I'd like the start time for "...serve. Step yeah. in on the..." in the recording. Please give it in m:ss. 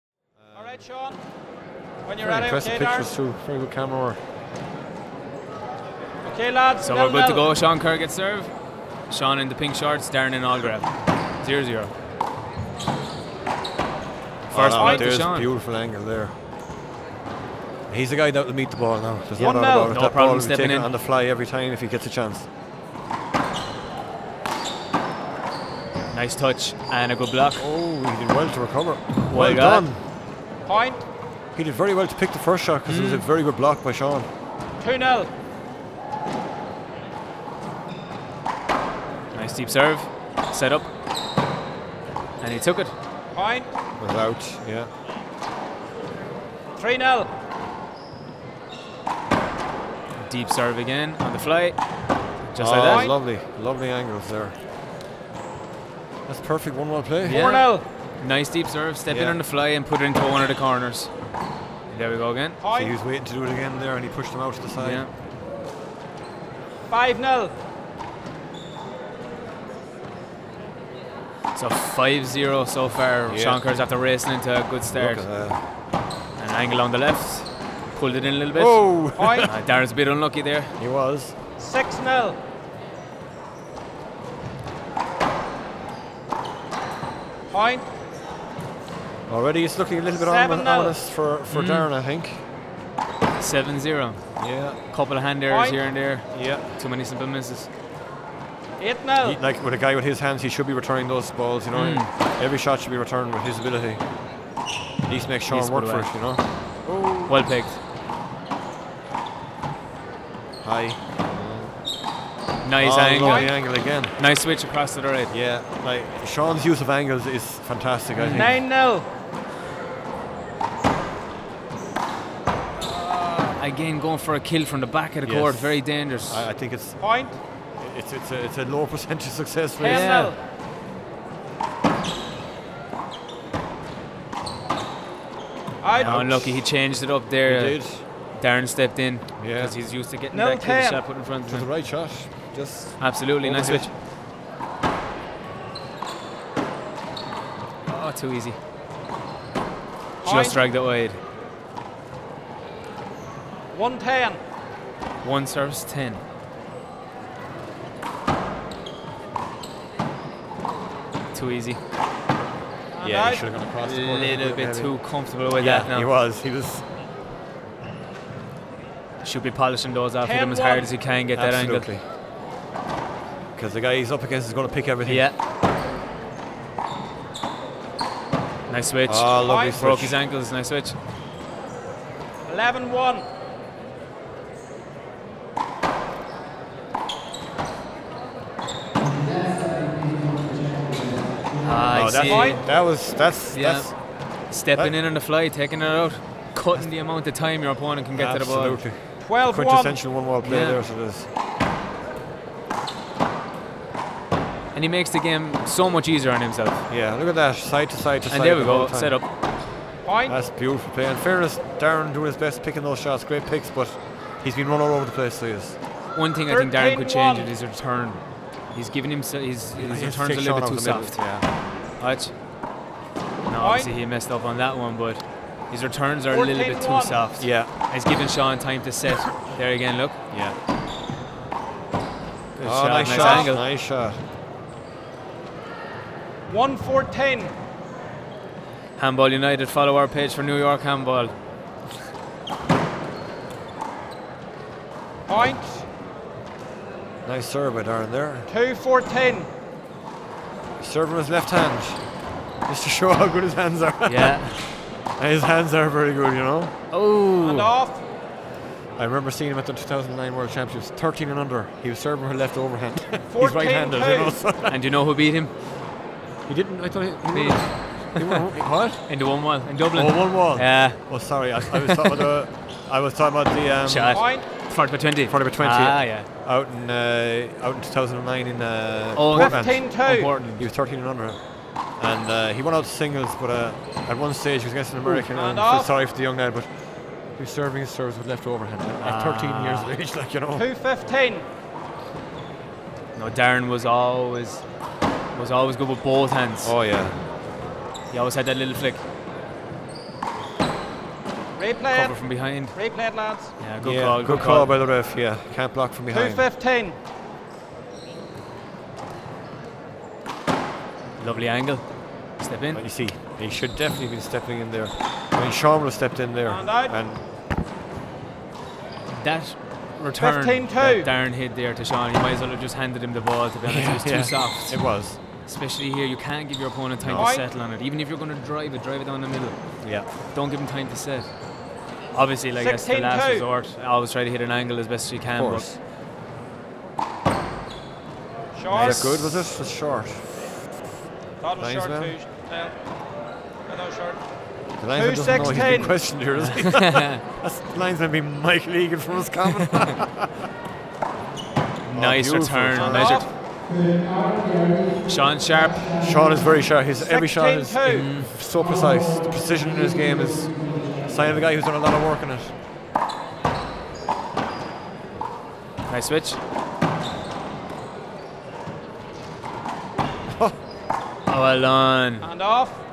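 0:58.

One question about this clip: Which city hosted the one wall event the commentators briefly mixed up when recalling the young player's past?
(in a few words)
Dublin.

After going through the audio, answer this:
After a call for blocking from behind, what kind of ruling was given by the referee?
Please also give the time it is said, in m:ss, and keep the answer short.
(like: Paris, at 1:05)
Replay, at 5:01.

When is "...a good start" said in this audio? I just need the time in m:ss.
1:14.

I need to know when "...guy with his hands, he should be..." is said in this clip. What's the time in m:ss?
1:39.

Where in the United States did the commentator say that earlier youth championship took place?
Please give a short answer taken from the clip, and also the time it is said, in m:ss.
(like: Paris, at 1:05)
Portland, at 4:39.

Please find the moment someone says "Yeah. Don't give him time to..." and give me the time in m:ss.
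5:29.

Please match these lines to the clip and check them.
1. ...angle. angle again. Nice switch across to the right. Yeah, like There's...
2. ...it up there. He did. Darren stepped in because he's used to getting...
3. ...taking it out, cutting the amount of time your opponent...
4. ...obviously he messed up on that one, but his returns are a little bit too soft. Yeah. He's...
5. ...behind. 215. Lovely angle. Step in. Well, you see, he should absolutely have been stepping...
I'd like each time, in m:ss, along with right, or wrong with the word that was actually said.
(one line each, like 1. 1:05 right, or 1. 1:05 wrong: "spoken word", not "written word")
1. 1:52 wrong: "Sean", not "There"
2. 2:17 right
3. 3:15 right
4. 3:43 right
5. 5:06 wrong: "definitely", not "absolutely".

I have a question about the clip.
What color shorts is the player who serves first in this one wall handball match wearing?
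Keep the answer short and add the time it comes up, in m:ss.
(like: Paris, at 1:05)
Pink, at 0:09.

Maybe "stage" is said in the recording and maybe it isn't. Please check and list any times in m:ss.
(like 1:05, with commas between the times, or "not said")
4:44.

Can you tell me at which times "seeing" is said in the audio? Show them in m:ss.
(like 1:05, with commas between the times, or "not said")
4:19.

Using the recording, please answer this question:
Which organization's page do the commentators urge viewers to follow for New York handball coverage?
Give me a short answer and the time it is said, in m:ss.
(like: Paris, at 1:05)
Handball United, at 3:58.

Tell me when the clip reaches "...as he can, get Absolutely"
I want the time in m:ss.
2:50.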